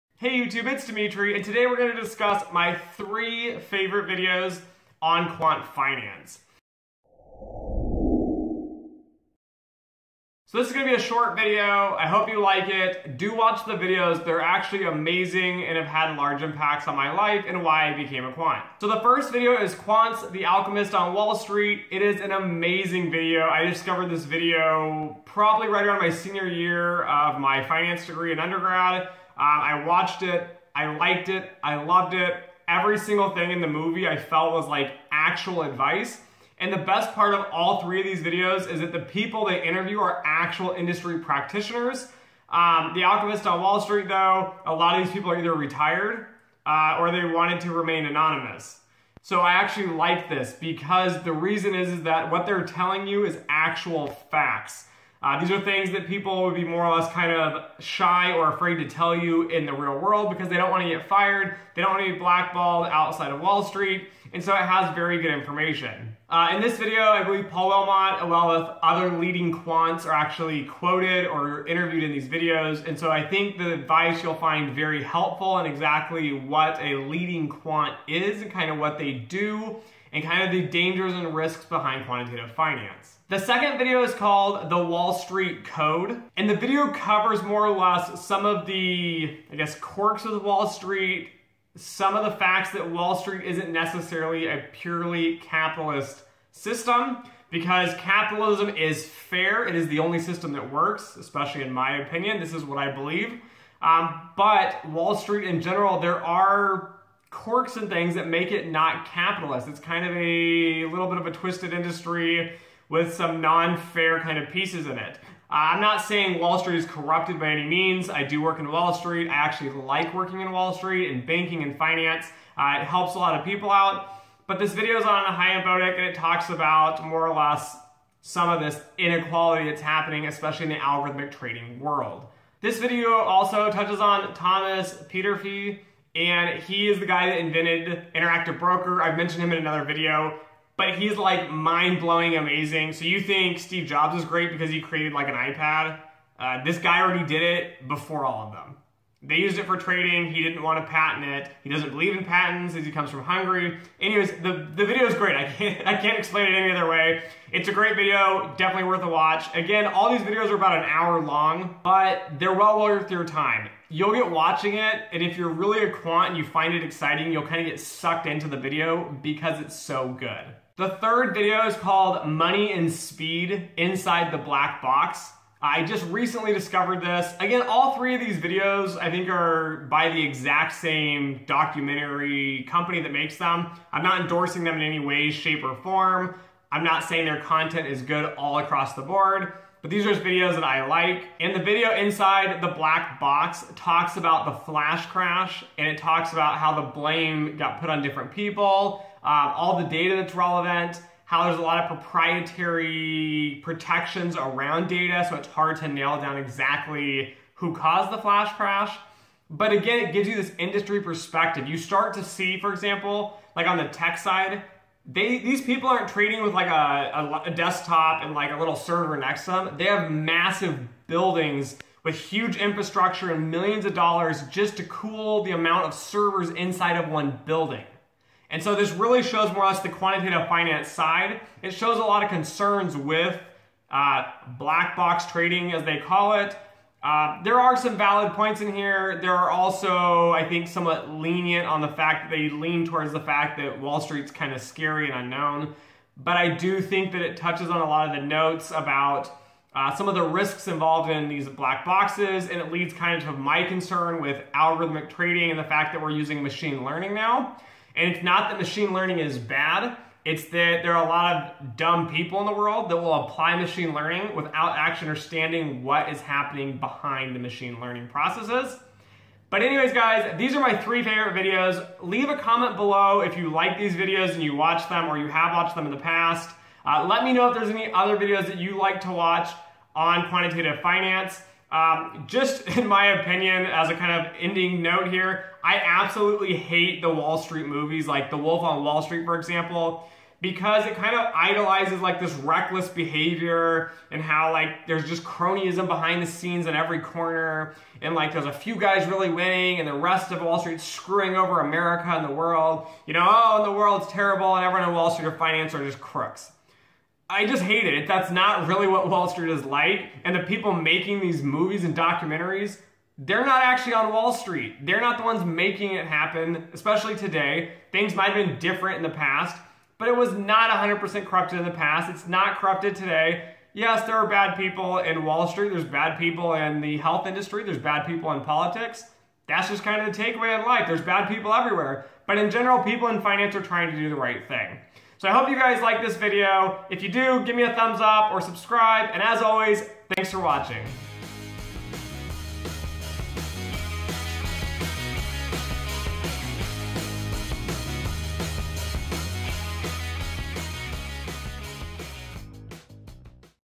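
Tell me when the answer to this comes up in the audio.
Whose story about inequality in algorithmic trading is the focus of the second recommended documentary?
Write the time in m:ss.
2:05.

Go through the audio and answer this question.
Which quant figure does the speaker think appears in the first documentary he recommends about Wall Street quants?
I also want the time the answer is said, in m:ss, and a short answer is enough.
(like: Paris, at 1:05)
Paul Wilmott, at 1:07.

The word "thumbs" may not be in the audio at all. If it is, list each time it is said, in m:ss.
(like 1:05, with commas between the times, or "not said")
5:37.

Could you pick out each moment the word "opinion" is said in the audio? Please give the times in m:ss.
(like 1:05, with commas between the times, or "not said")
1:42, 4:43.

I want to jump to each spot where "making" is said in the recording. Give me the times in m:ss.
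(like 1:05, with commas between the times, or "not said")
5:10, 5:15.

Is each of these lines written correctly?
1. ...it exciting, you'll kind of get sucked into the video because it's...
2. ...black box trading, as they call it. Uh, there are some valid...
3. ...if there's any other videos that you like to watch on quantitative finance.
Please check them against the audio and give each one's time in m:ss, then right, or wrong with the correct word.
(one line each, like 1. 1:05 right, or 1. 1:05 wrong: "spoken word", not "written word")
1. 2:46 right
2. 3:54 right
3. 4:37 right.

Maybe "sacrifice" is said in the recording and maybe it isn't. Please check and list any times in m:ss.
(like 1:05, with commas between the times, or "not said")
not said.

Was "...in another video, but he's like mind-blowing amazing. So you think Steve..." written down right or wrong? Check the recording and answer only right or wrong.
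right.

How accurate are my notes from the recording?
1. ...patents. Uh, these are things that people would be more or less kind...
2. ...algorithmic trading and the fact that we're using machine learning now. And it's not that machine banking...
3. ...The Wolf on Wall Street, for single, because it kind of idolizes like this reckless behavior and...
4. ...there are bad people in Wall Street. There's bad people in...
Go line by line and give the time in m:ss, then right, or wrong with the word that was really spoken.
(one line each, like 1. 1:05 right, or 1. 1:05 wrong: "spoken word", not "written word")
1. 0:54 wrong: "facts", not "patents"
2. 4:14 wrong: "learning", not "banking"
3. 4:48 wrong: "example", not "single"
4. 5:24 right.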